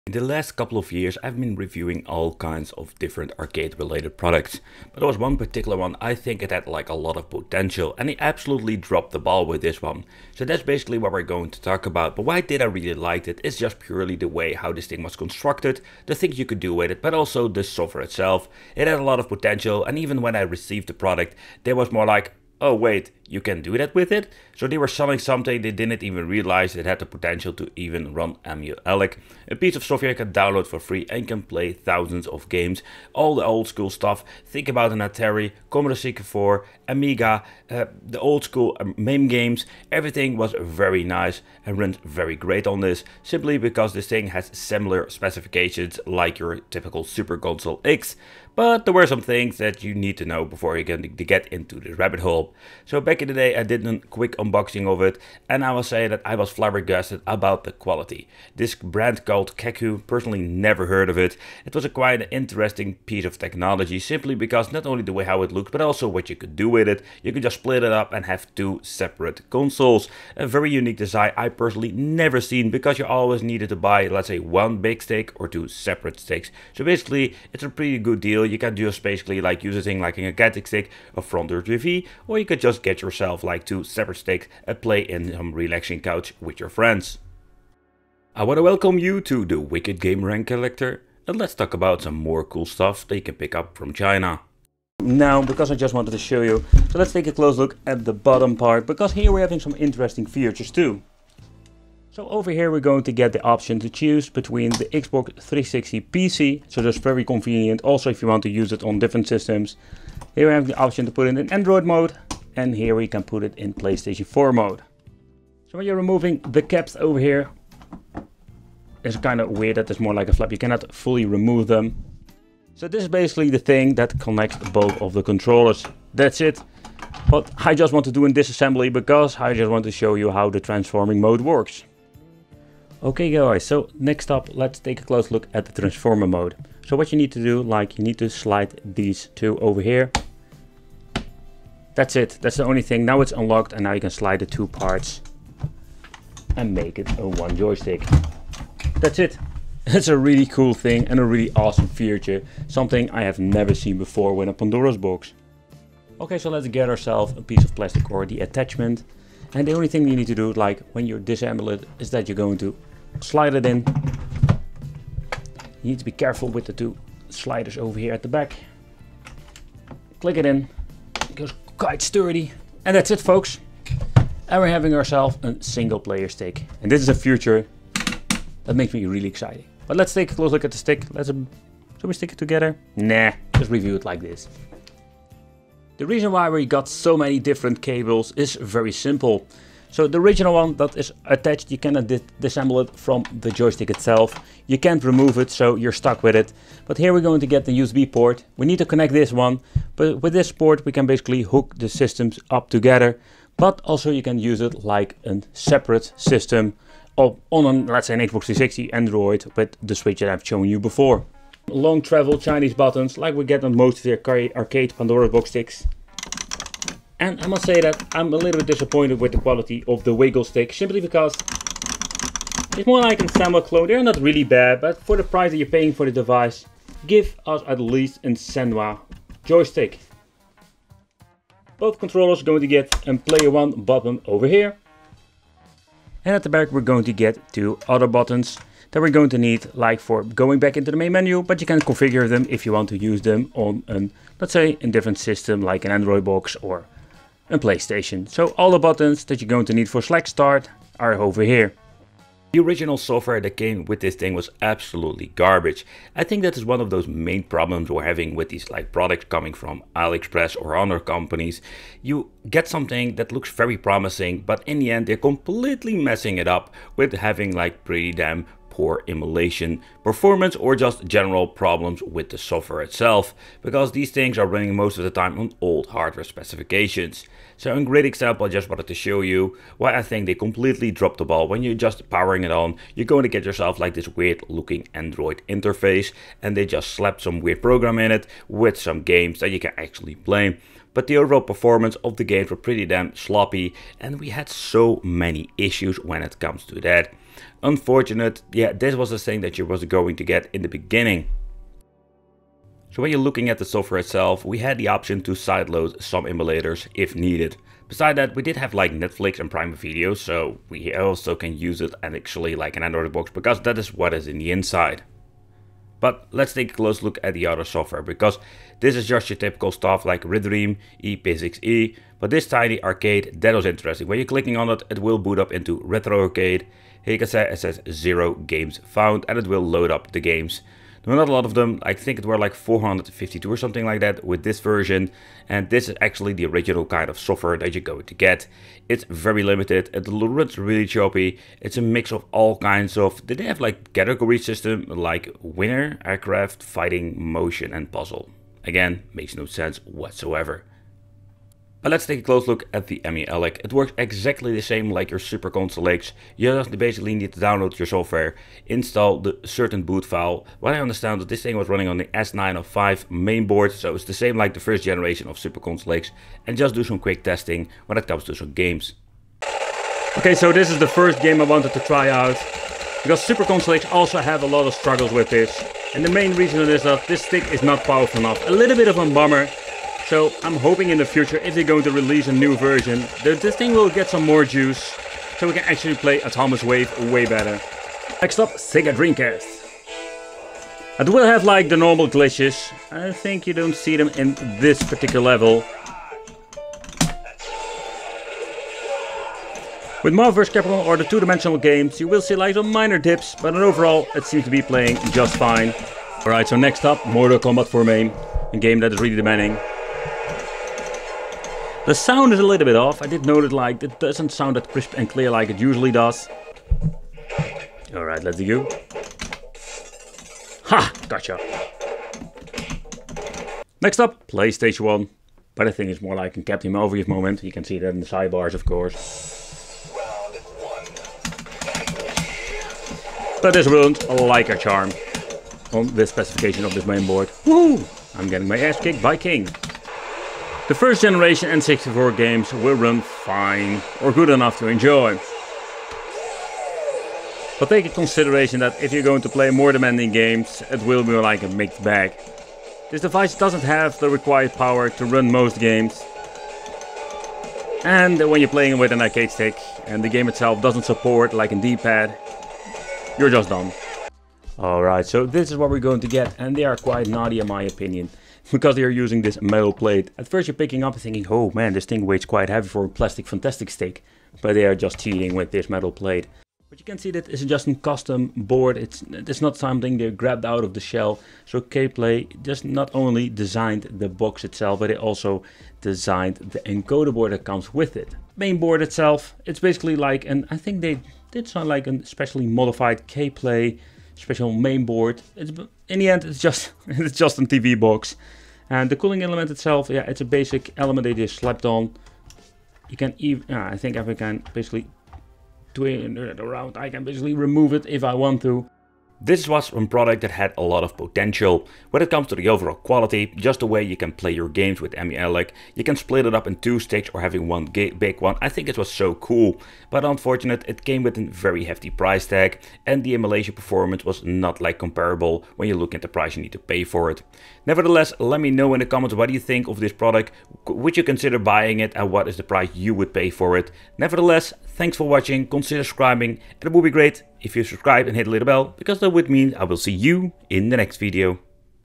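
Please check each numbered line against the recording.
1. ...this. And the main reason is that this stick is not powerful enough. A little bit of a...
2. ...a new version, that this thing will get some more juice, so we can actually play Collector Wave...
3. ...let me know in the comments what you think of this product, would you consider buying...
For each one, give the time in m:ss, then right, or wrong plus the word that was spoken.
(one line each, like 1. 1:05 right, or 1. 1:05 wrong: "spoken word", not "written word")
1. 6:15 right
2. 6:22 wrong: "Autonomous", not "Collector"
3. 8:48 right.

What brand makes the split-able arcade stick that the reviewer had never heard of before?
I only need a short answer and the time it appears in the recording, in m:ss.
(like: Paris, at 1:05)
Keku, at 0:59.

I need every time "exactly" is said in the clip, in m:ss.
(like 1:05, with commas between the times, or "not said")
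5:53.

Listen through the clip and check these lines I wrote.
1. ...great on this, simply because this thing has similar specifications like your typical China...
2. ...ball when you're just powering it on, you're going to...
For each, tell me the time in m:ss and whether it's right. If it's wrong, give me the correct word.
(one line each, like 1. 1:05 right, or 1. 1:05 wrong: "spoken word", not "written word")
1. 0:42 wrong: "Super", not "China"
2. 4:41 right.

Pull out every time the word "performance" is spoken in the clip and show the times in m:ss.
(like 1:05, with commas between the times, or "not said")
4:30, 4:51, 8:43.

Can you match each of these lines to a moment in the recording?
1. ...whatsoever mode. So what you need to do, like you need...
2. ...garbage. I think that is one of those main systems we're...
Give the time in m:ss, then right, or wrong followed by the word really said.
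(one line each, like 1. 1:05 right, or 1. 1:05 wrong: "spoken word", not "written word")
1. 2:15 wrong: "transformer", not "whatsoever"
2. 4:15 wrong: "problems", not "systems".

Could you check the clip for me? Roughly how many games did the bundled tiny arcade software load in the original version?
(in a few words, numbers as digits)
452.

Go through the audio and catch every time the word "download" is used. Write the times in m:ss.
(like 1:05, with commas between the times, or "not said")
0:30, 5:57.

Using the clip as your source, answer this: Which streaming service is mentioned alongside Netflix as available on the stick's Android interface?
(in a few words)
Prime Video.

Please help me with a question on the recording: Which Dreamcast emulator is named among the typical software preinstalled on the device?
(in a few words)
Redream.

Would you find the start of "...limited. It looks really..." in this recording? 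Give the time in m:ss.
5:39.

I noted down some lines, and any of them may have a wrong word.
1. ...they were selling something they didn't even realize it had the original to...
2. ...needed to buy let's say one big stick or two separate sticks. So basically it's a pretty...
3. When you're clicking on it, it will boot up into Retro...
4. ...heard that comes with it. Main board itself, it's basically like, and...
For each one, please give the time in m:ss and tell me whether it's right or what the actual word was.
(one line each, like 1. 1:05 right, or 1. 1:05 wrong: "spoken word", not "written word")
1. 0:24 wrong: "potential", not "original"
2. 1:13 right
3. 5:24 right
4. 8:07 wrong: "board", not "heard".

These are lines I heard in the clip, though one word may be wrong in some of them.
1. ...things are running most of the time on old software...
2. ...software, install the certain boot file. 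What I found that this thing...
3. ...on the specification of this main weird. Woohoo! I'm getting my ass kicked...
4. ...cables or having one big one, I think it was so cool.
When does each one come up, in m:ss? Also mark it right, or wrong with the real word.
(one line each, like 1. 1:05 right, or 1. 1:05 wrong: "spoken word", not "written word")
1. 4:34 wrong: "hardware", not "software"
2. 5:57 wrong: "understand", not "found"
3. 7:15 wrong: "board", not "weird"
4. 8:36 wrong: "stages", not "cables".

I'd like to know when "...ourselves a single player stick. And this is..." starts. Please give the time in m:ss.
2:54.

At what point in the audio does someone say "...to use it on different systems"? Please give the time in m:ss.
1:48.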